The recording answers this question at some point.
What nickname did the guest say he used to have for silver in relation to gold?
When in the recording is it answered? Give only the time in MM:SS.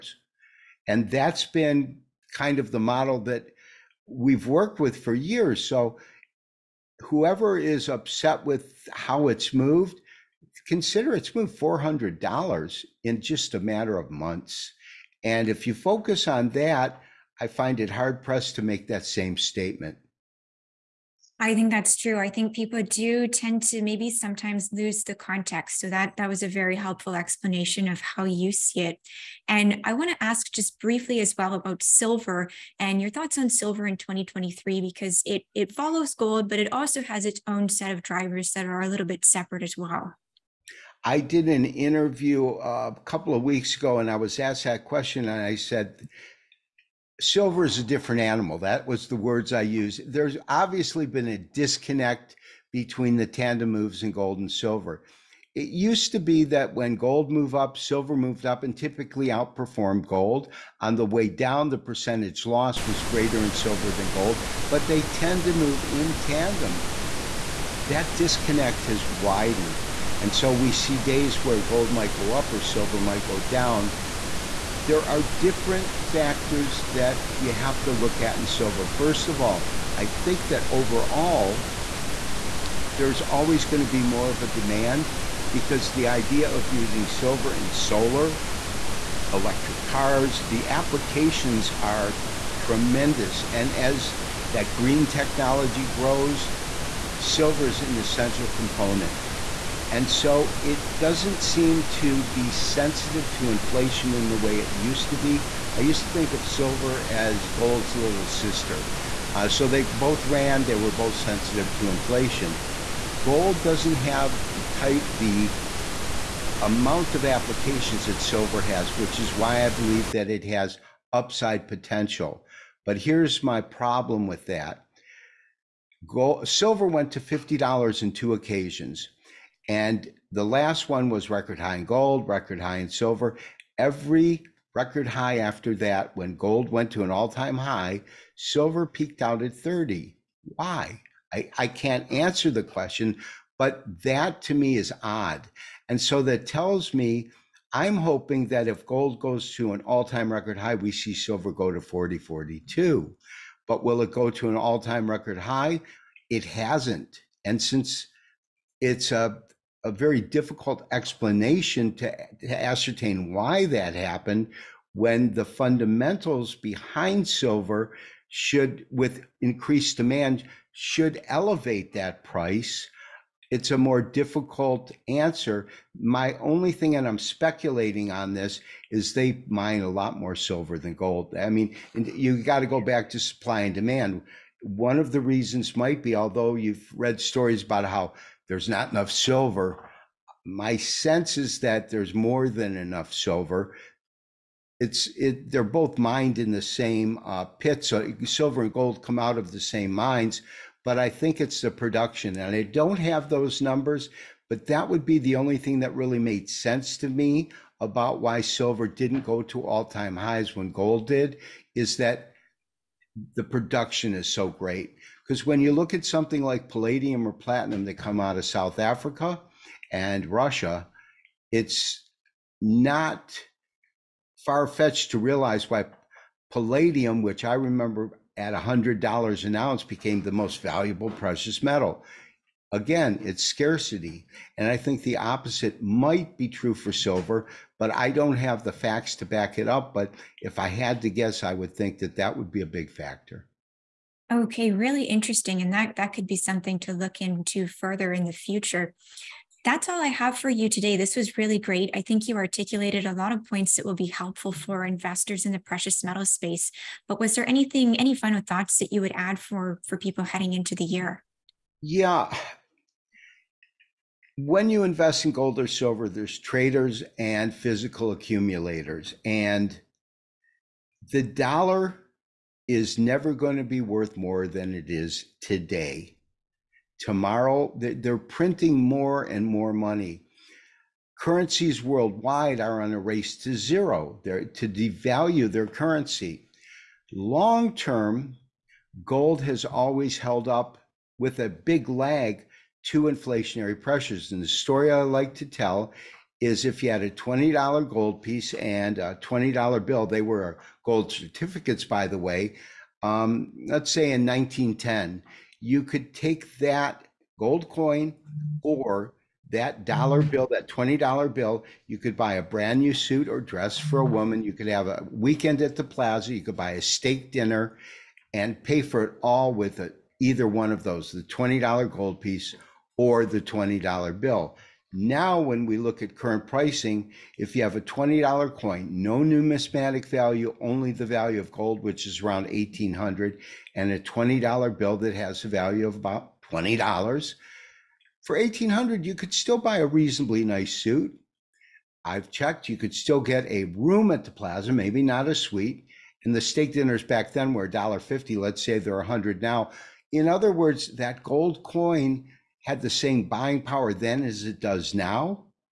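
01:47.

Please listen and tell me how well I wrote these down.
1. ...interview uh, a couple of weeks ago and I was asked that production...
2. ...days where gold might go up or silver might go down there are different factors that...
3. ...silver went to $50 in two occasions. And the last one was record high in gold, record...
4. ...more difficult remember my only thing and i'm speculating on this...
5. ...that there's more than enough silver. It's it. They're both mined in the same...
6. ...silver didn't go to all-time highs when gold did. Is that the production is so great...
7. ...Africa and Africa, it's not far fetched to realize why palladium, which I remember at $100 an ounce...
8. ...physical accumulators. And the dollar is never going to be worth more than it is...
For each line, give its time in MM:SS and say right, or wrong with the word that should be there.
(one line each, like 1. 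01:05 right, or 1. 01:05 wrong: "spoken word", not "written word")
1. 00:41 wrong: "question", not "production"
2. 01:10 right
3. 02:06 right
4. 02:53 wrong: "answer", not "remember"
5. 03:11 right
6. 03:28 right
7. 03:38 wrong: "Russia", not "Africa"
8. 04:27 right.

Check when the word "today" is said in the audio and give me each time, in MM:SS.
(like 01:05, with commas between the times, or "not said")
04:10, 04:35.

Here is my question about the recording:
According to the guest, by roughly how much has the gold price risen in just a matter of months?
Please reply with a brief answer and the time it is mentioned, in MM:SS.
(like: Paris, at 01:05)
$400, at 00:11.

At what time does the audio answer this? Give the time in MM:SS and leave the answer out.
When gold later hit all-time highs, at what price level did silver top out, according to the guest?
02:19.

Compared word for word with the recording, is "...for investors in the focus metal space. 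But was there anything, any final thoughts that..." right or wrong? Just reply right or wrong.
wrong.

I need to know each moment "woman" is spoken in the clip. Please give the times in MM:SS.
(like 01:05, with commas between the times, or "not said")
05:14.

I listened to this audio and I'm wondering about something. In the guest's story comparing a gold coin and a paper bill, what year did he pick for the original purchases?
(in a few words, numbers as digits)
1910.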